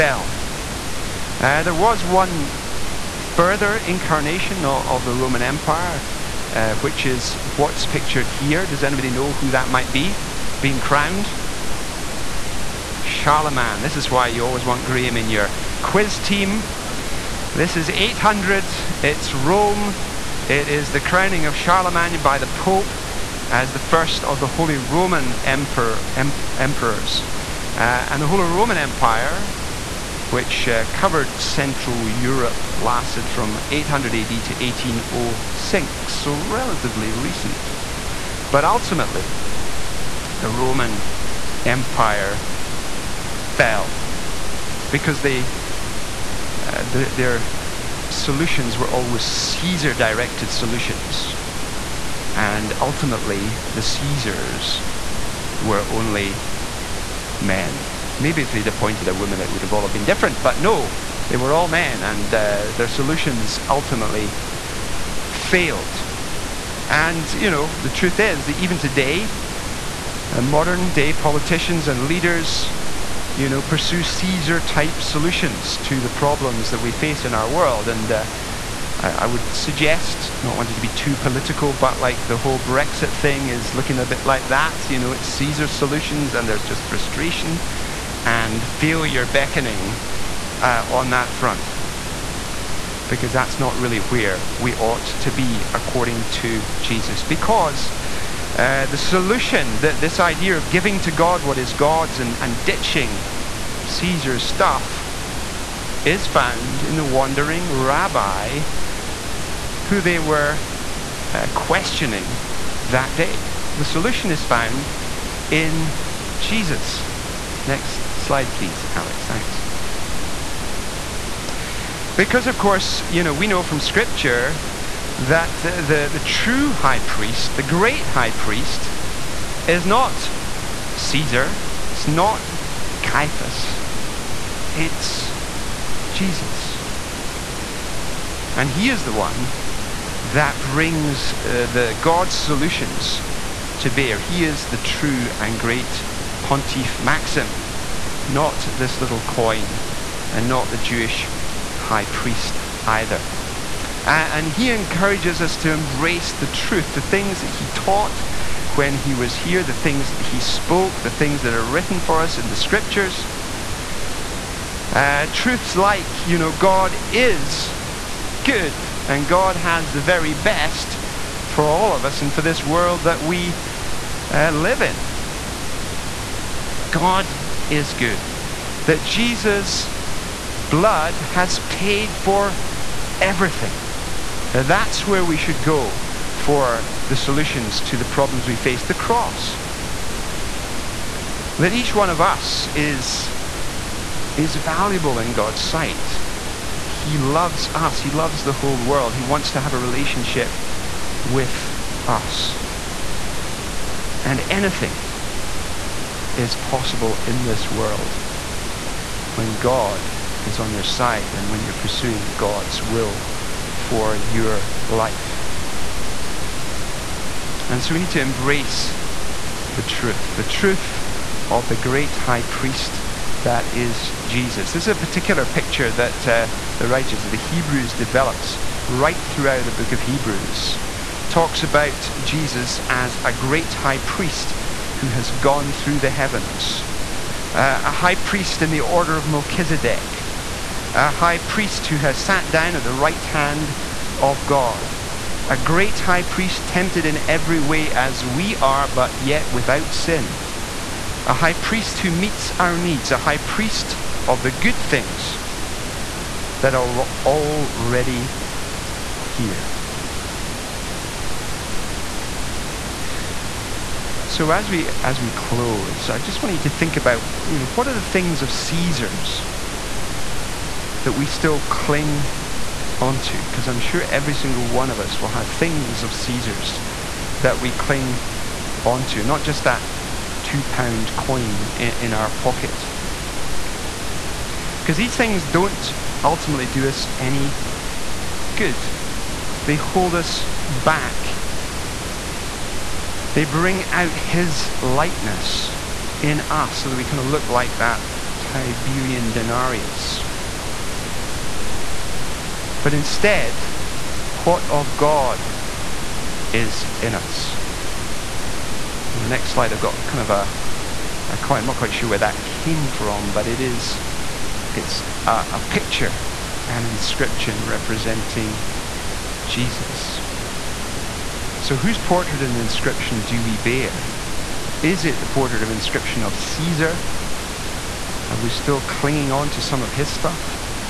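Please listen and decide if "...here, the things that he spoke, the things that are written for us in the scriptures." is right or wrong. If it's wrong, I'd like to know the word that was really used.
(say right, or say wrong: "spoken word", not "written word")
right.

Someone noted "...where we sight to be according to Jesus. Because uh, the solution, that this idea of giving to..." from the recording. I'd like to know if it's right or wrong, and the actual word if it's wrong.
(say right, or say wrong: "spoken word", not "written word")
wrong: "ought", not "sight".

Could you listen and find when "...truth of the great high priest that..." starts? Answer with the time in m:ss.
3:40.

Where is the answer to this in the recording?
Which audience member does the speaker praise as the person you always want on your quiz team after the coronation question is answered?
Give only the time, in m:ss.
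0:14.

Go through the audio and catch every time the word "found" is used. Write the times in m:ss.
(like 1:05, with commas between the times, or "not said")
1:46, 1:54.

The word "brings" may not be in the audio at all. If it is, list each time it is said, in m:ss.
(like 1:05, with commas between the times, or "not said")
2:20, 4:53.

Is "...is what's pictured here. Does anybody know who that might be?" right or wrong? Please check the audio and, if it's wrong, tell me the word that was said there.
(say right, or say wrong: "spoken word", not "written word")
right.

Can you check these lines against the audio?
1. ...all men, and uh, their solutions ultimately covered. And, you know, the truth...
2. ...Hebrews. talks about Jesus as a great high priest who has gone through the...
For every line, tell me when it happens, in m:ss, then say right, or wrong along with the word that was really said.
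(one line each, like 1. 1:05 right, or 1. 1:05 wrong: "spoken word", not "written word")
1. 1:01 wrong: "failed", not "covered"
2. 3:50 right.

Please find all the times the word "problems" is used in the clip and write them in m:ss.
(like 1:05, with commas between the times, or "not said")
1:16, 3:08.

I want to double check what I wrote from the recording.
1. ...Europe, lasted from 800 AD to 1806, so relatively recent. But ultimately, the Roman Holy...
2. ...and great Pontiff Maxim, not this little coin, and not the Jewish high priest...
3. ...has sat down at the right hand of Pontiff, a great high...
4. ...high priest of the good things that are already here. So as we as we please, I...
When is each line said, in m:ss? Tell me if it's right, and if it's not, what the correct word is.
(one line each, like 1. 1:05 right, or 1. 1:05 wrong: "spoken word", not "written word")
1. 0:32 wrong: "Empire", not "Holy"
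2. 2:25 right
3. 4:01 wrong: "God", not "Pontiff"
4. 4:13 wrong: "close", not "please".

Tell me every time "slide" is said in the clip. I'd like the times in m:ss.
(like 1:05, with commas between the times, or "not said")
1:58, 5:09.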